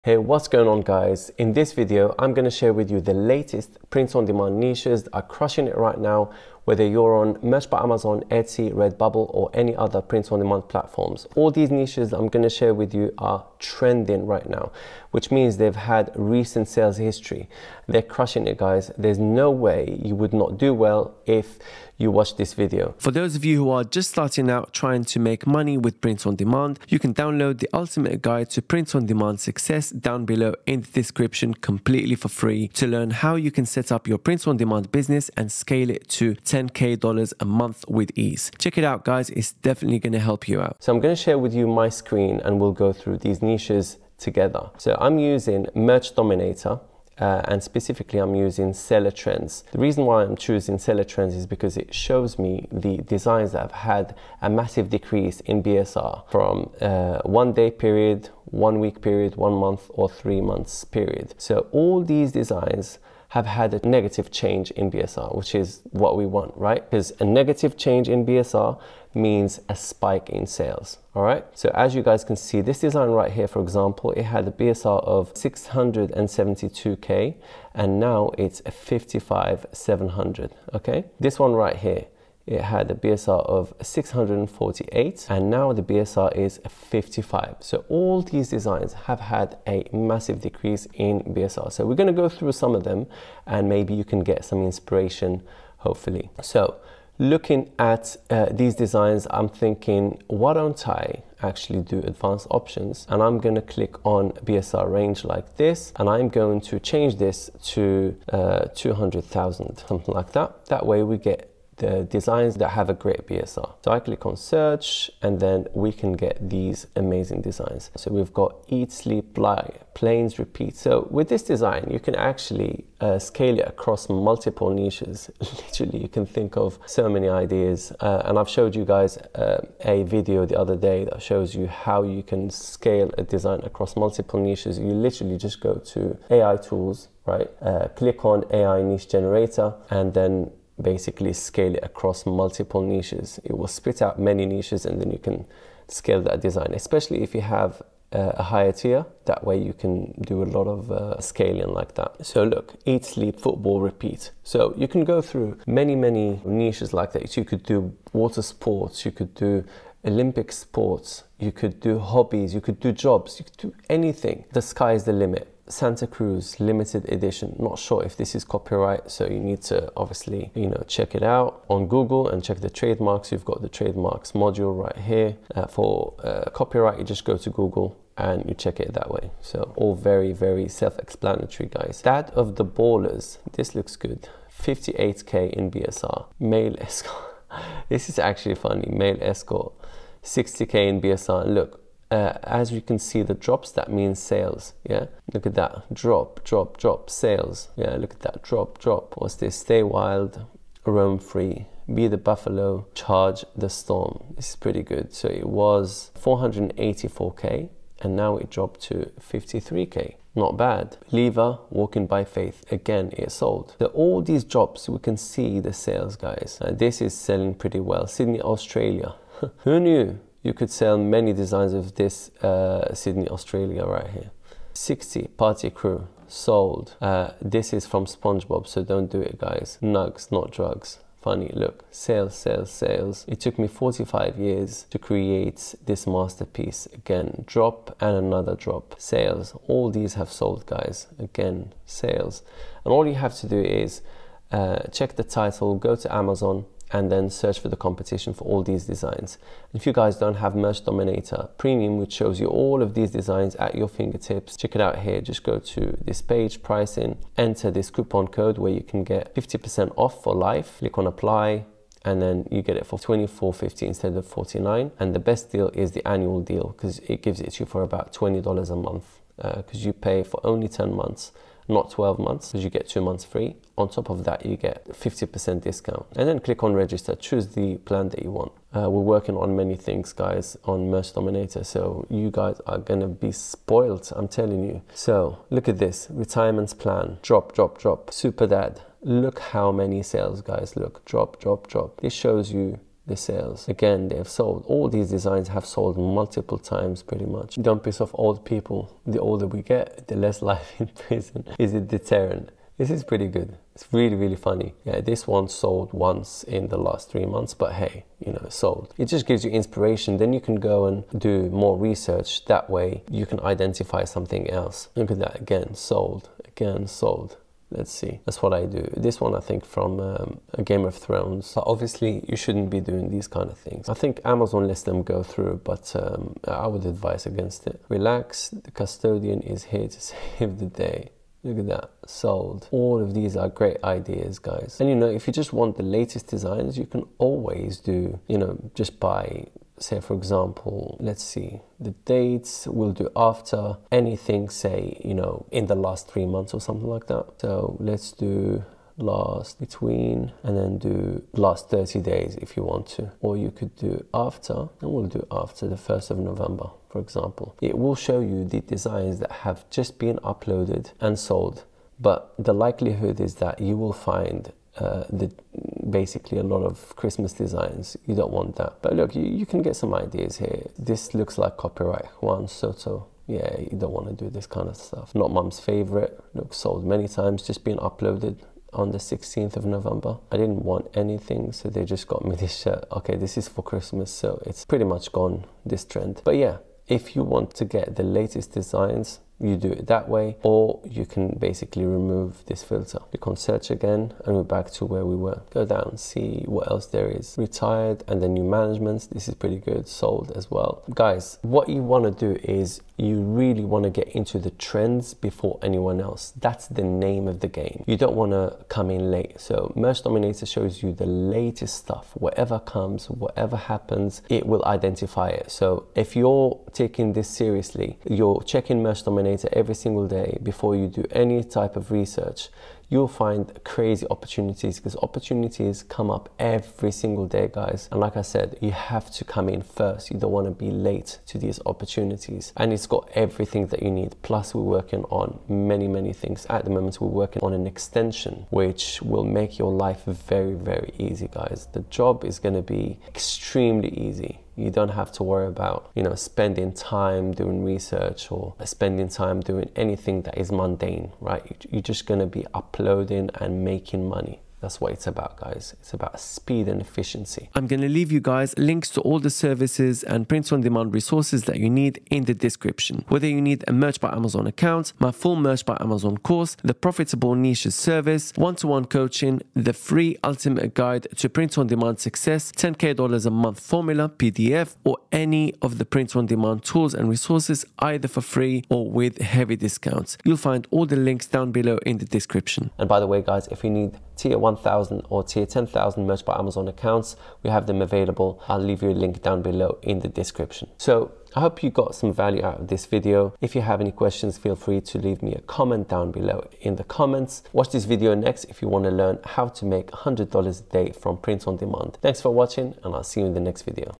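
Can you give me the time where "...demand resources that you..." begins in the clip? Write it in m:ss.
7:40.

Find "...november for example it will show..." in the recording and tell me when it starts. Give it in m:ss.
5:56.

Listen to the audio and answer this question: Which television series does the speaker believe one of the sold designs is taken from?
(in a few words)
Game of Thrones.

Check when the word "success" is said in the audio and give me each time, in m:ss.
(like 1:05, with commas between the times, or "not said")
0:29, 7:51.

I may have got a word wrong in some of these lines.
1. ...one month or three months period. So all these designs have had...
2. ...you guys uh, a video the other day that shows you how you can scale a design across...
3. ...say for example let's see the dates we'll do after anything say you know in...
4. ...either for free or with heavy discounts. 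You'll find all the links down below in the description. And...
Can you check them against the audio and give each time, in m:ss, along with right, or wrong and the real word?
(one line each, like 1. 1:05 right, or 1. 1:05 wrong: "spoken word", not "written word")
1. 0:59 right
2. 2:08 right
3. 5:39 right
4. 7:57 right.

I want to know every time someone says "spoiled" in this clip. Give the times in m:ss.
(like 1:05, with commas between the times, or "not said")
4:43.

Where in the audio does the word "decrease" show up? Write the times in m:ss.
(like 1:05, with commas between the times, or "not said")
0:54, 1:30.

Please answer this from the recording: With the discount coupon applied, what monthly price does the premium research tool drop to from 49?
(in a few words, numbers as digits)
24.50.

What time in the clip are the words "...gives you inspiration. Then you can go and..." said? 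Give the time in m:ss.
5:09.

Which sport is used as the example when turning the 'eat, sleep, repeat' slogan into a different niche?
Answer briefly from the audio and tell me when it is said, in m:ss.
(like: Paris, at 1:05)
football, at 2:33.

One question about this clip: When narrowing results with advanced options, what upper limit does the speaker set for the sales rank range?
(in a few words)
200,000.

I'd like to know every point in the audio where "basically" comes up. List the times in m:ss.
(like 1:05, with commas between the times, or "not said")
2:20, 6:05, 6:31.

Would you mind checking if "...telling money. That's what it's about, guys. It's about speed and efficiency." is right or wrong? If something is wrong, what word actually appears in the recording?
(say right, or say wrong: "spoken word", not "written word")
wrong: "making", not "telling".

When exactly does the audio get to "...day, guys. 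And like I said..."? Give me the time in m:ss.
7:07.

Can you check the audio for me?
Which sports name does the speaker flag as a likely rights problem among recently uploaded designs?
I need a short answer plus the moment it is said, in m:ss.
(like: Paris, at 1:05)
Juan Soto, at 6:12.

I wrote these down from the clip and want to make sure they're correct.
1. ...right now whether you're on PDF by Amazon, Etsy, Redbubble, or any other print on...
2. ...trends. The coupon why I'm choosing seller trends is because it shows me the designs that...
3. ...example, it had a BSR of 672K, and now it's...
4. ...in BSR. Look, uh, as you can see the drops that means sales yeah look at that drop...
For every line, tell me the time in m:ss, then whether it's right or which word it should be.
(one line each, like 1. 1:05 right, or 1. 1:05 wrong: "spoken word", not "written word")
1. 0:05 wrong: "Merch", not "PDF"
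2. 0:49 wrong: "reason", not "coupon"
3. 1:13 right
4. 3:10 right.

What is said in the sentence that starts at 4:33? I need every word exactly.
On top of that, you get 50% discount.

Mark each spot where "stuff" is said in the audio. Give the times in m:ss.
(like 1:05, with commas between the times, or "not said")
6:14, 6:51.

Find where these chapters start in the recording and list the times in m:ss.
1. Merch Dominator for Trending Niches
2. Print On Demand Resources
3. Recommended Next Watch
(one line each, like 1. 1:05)
1. 0:40
2. 7:40
3. 8:11.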